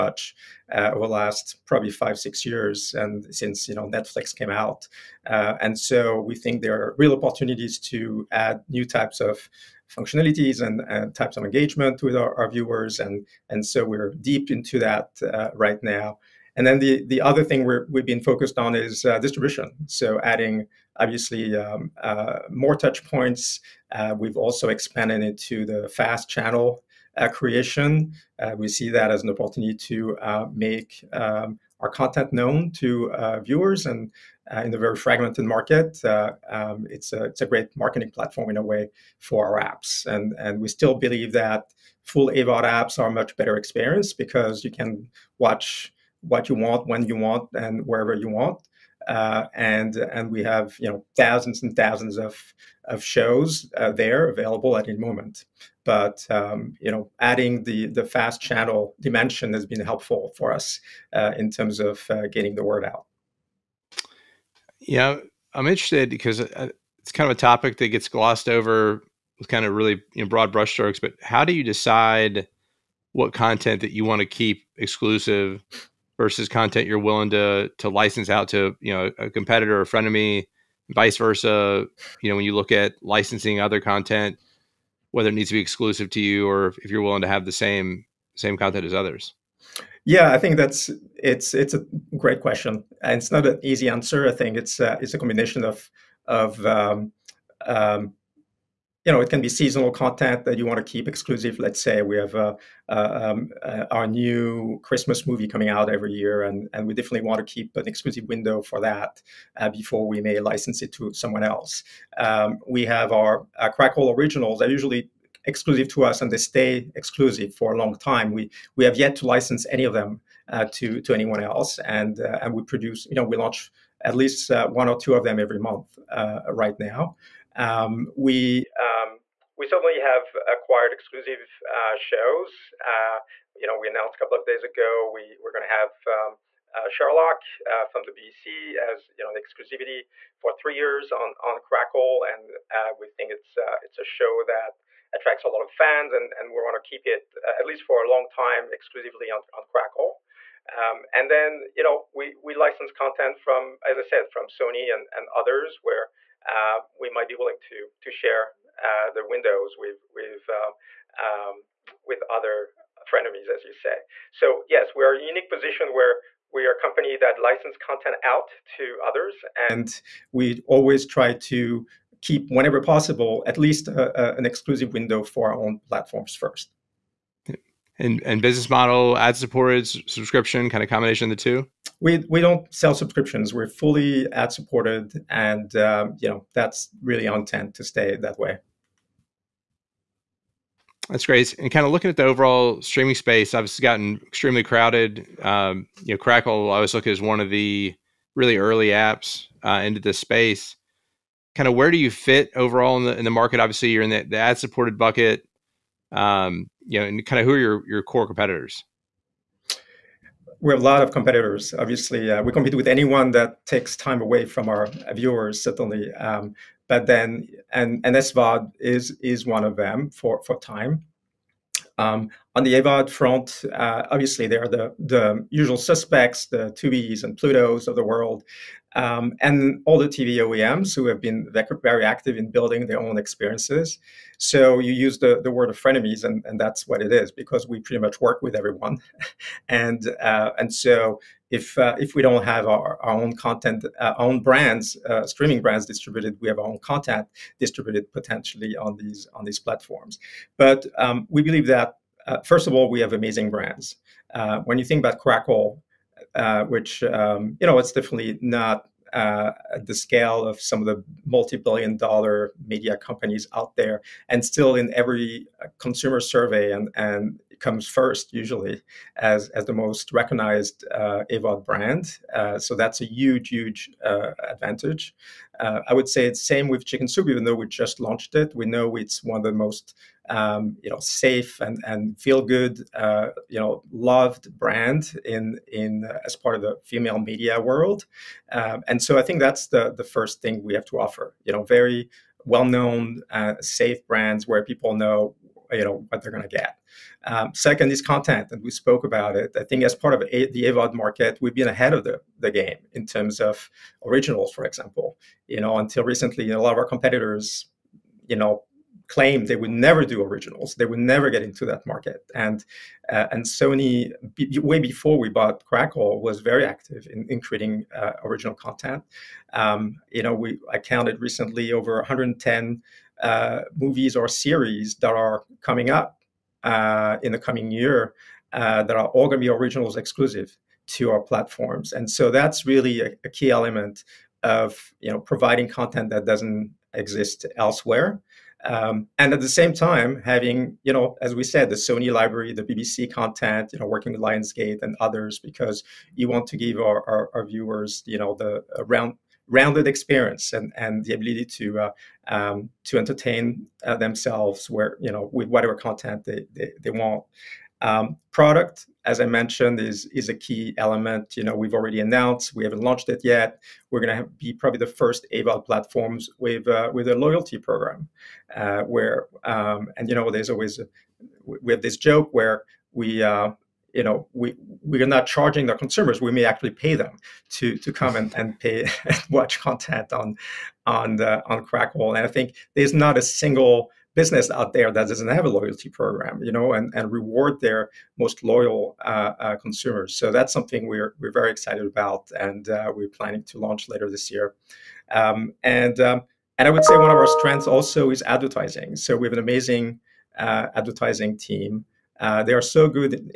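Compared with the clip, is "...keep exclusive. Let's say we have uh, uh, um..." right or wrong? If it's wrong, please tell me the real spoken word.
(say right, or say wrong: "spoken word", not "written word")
right.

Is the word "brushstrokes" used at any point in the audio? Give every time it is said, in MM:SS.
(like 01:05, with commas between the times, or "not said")
01:10.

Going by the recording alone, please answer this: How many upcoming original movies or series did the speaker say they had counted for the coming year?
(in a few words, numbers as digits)
110.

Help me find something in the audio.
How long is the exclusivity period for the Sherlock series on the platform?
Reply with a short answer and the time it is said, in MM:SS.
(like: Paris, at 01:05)
3 years, at 02:20.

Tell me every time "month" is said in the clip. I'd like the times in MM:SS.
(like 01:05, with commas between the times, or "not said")
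02:05.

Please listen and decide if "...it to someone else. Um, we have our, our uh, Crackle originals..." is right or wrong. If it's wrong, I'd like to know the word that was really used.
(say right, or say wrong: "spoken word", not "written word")
right.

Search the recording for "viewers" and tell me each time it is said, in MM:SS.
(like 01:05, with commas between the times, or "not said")
00:12, 00:33, 03:35, 05:47.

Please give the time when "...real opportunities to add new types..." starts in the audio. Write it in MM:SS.
00:06.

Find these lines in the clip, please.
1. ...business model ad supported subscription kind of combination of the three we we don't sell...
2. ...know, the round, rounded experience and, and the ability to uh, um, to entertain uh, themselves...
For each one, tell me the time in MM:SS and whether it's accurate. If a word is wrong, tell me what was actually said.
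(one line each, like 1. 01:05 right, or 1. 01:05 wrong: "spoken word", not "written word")
1. 02:58 wrong: "two", not "three"
2. 05:48 right.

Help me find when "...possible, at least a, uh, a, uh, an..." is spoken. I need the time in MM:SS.
02:52.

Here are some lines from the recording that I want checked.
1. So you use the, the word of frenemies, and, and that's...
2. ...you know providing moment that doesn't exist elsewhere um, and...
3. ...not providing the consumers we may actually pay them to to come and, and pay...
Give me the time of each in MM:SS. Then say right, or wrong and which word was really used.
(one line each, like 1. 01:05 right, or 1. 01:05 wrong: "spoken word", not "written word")
1. 03:54 right
2. 05:35 wrong: "content", not "moment"
3. 06:15 wrong: "charging", not "providing".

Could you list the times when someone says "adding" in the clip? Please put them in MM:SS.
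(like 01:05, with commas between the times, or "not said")
00:20, 00:57.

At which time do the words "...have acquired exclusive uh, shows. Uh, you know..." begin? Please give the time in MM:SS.
02:09.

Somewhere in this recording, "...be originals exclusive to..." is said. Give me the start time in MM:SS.
05:29.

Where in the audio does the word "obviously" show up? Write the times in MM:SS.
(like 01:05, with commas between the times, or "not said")
00:20, 03:13, 03:23, 03:31, 03:44.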